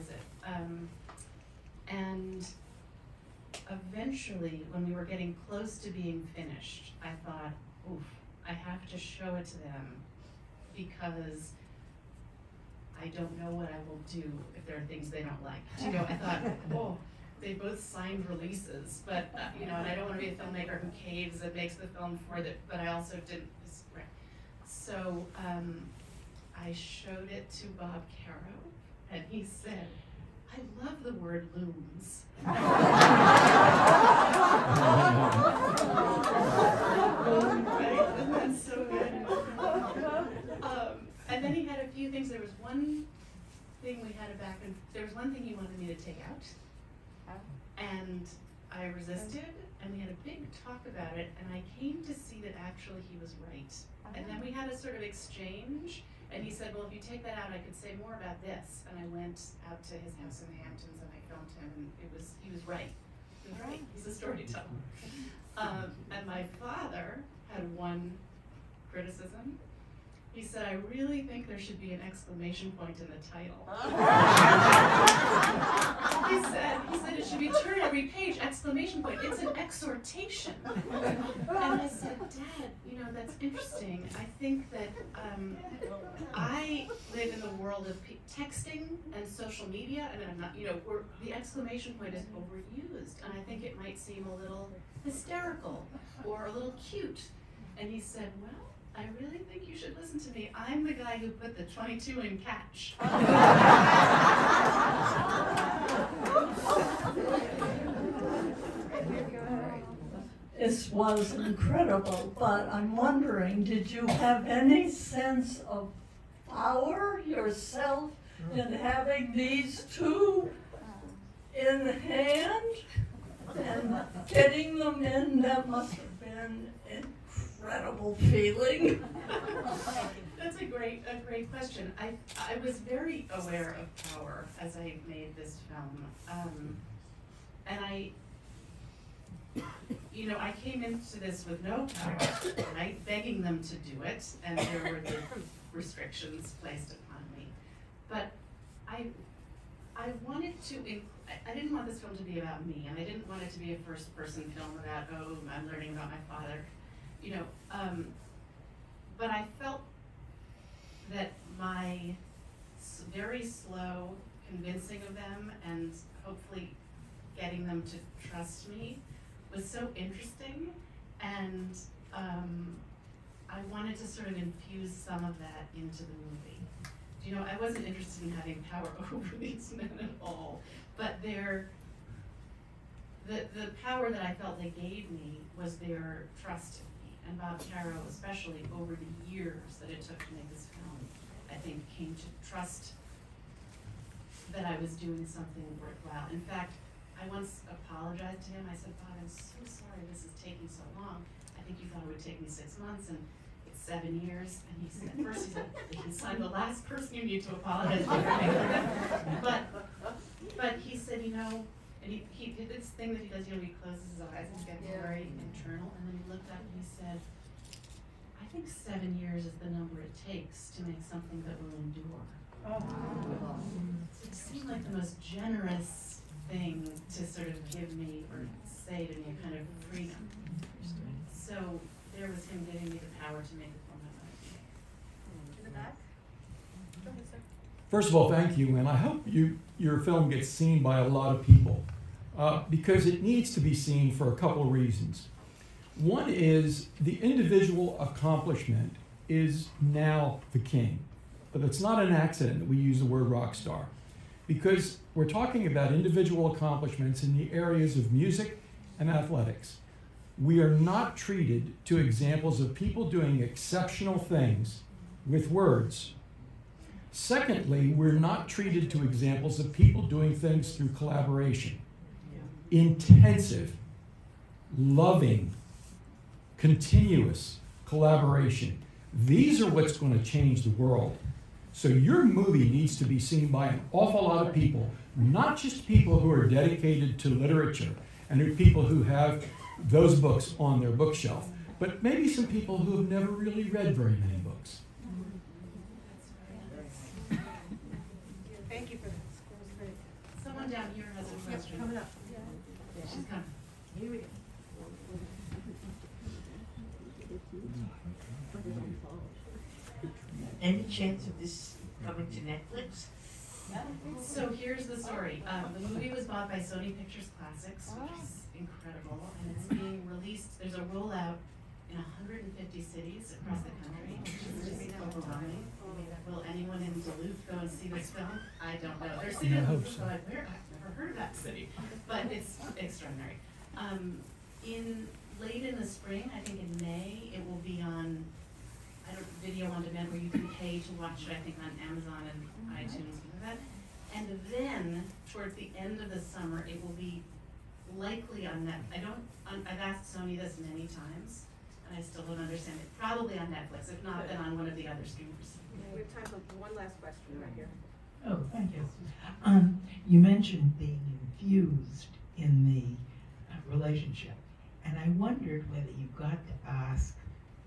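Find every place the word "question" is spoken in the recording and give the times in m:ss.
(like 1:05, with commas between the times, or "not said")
2:11, 5:01, 5:57.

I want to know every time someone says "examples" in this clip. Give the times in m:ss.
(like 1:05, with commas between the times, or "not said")
4:21, 4:29.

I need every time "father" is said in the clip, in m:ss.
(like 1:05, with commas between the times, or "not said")
1:06, 2:36.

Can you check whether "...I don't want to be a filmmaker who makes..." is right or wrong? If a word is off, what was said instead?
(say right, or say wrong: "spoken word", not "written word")
wrong: "caves", not "makes".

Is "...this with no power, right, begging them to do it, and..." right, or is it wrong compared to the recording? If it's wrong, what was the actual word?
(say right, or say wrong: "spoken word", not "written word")
right.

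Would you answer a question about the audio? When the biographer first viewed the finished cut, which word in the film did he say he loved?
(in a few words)
looms.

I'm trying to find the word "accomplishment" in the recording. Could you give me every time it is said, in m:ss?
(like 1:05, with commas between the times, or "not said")
4:07, 4:16.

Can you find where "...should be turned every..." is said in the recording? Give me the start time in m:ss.
1:17.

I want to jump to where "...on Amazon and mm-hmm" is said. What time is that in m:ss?
5:41.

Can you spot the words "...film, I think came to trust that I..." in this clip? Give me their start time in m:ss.
3:10.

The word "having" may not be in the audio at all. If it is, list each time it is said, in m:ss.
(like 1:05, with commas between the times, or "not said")
1:58, 2:58.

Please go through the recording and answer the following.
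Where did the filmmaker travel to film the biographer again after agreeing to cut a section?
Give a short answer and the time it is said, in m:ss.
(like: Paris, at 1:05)
the Hamptons, at 1:00.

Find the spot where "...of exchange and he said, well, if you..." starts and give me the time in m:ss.
0:54.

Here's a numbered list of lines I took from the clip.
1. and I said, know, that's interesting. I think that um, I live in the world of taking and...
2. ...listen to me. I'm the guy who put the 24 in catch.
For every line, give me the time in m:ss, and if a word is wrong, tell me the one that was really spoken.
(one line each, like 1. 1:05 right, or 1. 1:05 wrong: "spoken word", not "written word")
1. 1:21 wrong: "texting", not "taking"
2. 1:39 wrong: "22", not "24".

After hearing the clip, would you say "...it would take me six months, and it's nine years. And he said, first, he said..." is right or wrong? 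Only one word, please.
wrong.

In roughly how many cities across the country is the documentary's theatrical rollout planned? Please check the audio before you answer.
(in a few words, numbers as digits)
150.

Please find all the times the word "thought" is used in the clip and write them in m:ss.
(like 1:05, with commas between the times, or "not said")
0:07, 0:16, 3:21.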